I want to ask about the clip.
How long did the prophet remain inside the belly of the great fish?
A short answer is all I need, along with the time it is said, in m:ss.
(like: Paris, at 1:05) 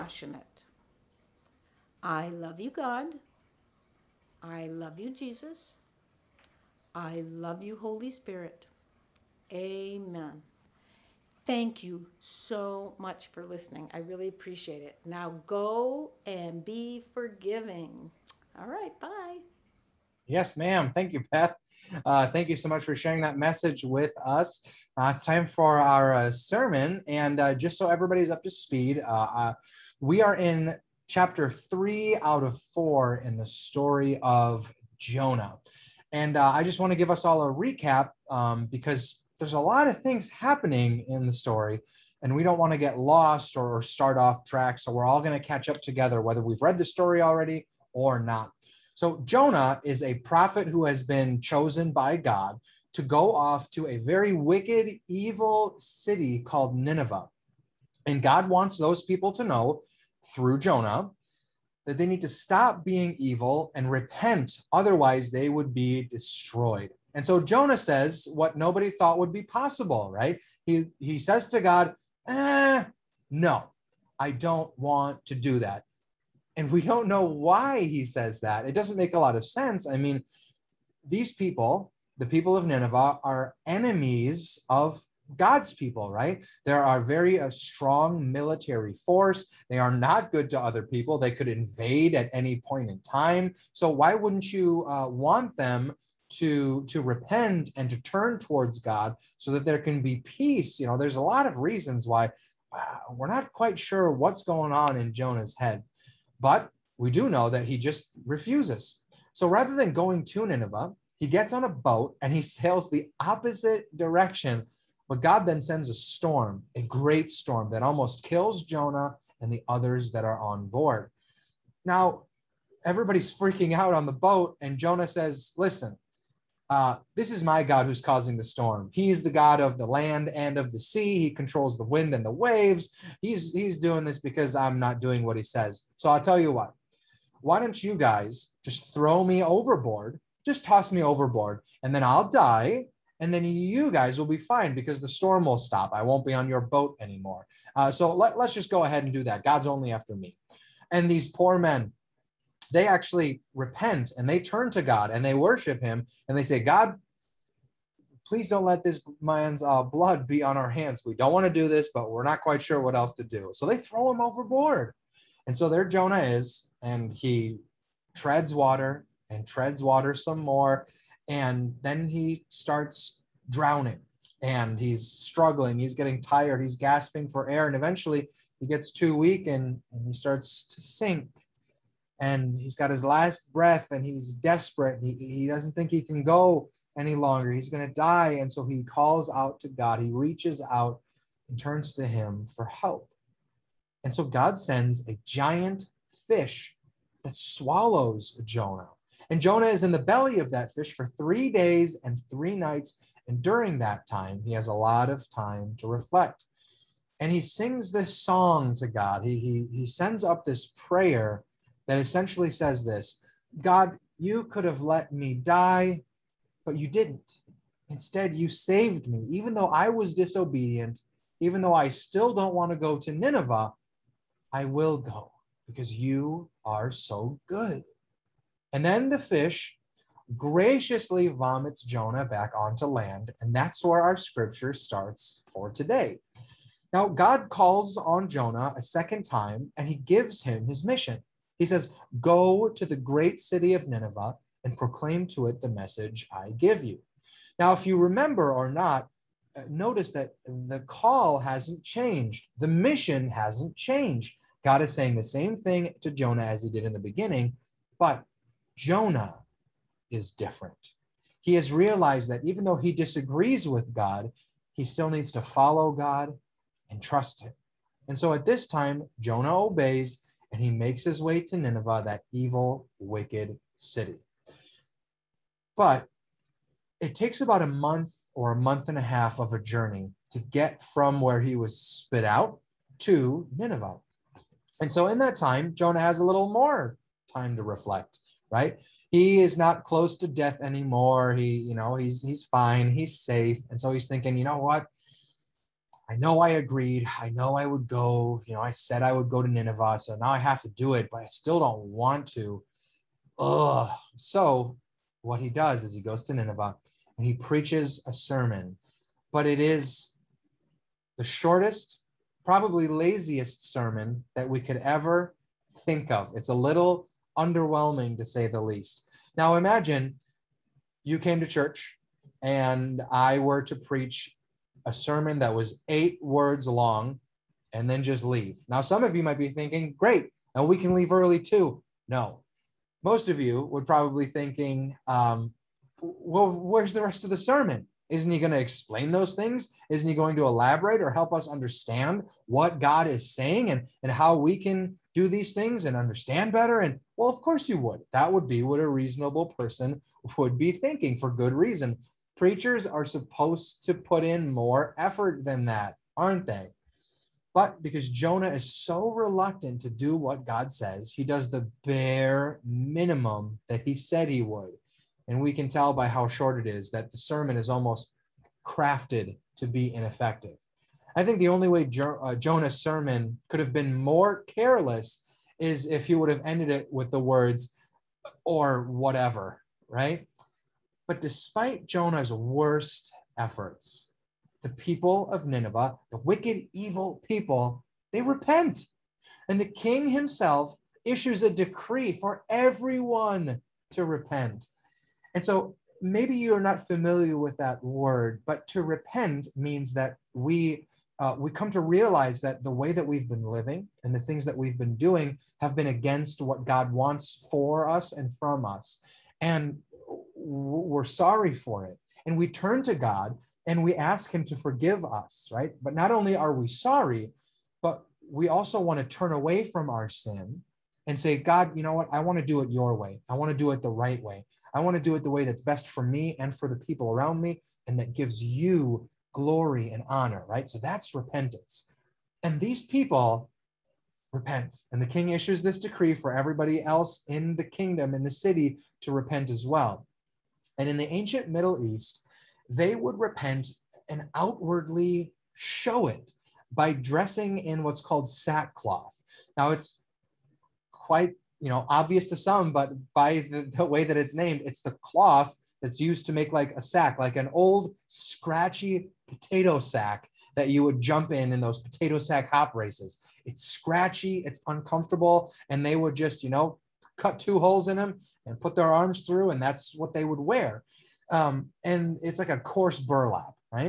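3 days and 3 nights, at 3:21.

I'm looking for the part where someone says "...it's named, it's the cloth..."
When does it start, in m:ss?
7:34.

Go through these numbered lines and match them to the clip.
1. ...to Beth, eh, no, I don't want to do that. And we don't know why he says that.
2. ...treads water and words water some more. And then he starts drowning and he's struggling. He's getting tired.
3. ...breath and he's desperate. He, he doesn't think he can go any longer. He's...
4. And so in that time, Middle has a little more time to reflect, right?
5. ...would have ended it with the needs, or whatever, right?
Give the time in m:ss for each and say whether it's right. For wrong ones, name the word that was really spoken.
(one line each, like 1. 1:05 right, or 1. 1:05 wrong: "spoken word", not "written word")
1. 1:11 wrong: "God", not "Beth"
2. 2:48 wrong: "treads", not "words"
3. 3:03 right
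4. 4:44 wrong: "Jonah", not "Middle"
5. 6:16 wrong: "words", not "needs".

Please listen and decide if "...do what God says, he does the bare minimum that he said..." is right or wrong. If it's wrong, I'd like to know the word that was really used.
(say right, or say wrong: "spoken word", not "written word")
right.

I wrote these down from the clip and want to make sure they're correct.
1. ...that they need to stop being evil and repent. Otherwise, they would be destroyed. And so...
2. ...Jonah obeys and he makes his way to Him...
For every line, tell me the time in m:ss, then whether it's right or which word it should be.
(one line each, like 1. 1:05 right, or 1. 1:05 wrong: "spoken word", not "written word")
1. 1:01 right
2. 4:29 wrong: "Nineveh", not "Him".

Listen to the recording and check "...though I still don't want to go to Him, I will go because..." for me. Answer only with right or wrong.
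wrong.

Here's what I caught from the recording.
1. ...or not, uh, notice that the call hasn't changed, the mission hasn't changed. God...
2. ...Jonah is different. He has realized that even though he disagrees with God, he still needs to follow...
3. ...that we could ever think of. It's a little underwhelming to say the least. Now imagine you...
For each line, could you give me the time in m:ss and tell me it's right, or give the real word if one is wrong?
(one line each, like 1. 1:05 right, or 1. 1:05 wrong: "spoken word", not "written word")
1. 4:08 right
2. 4:18 right
3. 5:14 right.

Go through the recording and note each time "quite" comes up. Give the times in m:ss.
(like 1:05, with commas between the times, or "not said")
1:43, 2:42, 7:30.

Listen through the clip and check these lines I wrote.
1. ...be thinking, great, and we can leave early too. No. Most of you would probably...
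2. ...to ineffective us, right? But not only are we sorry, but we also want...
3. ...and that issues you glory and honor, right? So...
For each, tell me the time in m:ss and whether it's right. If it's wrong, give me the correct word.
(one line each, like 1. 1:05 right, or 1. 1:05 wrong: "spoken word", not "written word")
1. 5:29 right
2. 6:54 wrong: "forgive", not "ineffective"
3. 7:07 wrong: "gives", not "issues".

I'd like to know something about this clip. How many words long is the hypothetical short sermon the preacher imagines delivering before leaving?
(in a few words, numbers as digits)
8.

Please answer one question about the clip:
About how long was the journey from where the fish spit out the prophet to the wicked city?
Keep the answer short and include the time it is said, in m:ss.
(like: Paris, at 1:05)
a month or a month and a half, at 4:37.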